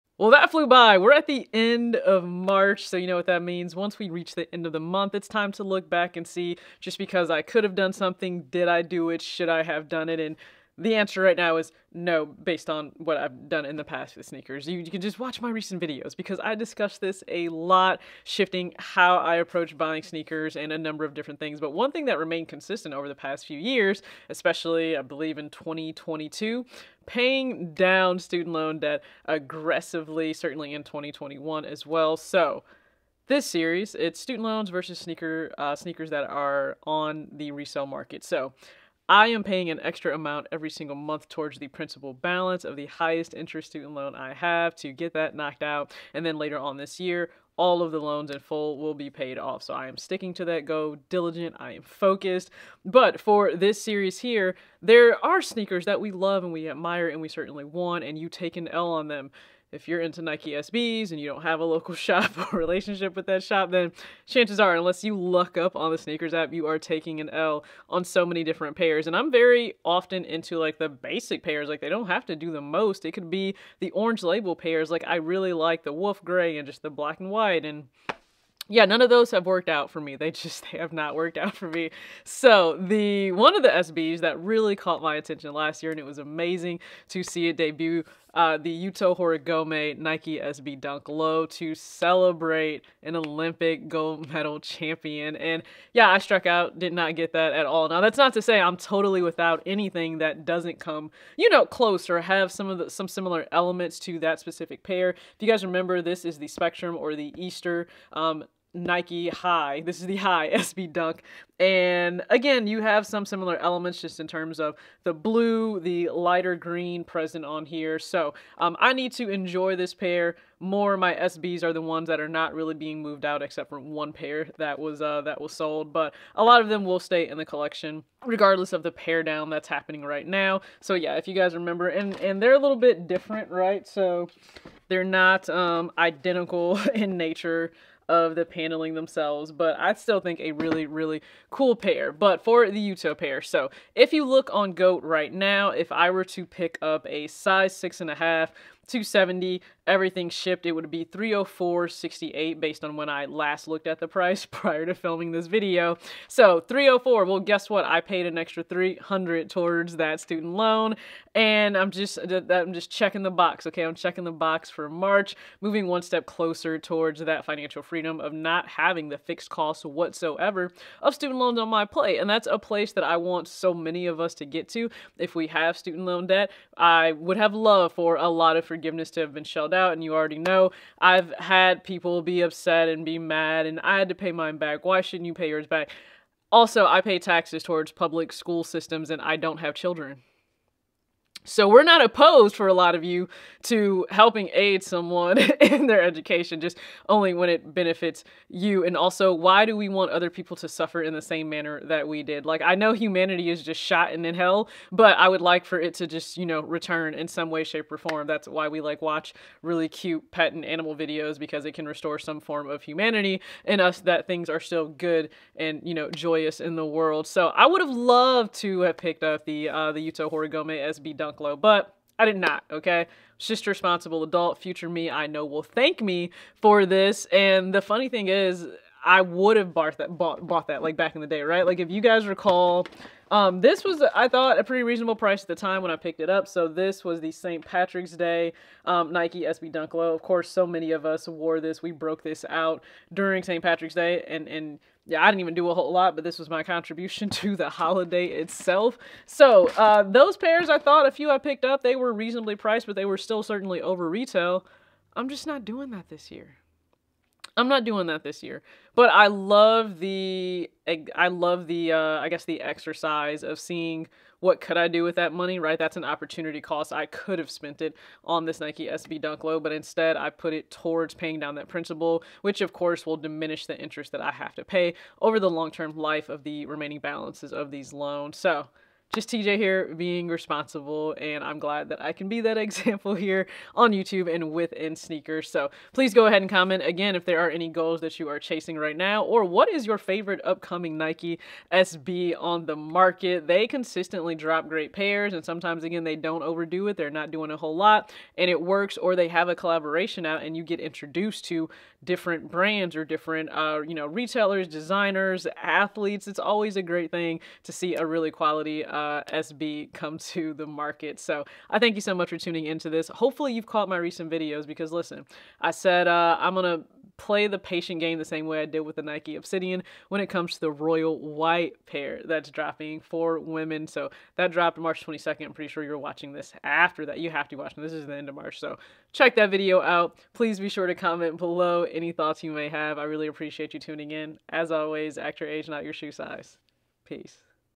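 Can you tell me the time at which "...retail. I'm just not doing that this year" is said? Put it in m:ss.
4:14.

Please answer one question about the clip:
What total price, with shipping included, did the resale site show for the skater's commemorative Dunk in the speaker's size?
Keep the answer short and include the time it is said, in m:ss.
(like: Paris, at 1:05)
$304.68, at 2:31.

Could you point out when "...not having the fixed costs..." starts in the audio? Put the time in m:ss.
2:48.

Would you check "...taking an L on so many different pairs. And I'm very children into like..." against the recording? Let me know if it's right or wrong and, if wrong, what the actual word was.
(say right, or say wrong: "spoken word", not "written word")
wrong: "often", not "children".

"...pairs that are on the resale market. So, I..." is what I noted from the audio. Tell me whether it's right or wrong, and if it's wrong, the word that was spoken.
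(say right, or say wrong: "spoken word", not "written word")
wrong: "sneakers", not "pairs".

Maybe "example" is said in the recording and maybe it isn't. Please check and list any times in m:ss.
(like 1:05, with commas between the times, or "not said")
4:42.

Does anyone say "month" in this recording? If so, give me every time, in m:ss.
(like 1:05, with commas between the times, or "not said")
0:04, 0:40.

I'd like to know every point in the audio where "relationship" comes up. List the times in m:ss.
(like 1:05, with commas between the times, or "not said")
1:02.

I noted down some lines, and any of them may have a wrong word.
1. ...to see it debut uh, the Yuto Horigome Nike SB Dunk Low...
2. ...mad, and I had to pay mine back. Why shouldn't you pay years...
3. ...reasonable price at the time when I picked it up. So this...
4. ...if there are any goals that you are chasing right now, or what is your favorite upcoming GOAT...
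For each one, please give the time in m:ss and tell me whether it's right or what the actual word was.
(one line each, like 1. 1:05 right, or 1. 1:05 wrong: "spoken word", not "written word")
1. 1:27 right
2. 3:03 wrong: "yours", not "years"
3. 3:54 right
4. 4:47 wrong: "Nike", not "GOAT".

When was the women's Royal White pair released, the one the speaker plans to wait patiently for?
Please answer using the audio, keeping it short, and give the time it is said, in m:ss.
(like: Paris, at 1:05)
March 22, at 5:24.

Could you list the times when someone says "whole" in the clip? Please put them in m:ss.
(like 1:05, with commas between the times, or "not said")
4:05, 4:57.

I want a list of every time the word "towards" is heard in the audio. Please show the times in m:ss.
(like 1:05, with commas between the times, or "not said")
0:41, 2:39, 2:46, 3:07, 4:30.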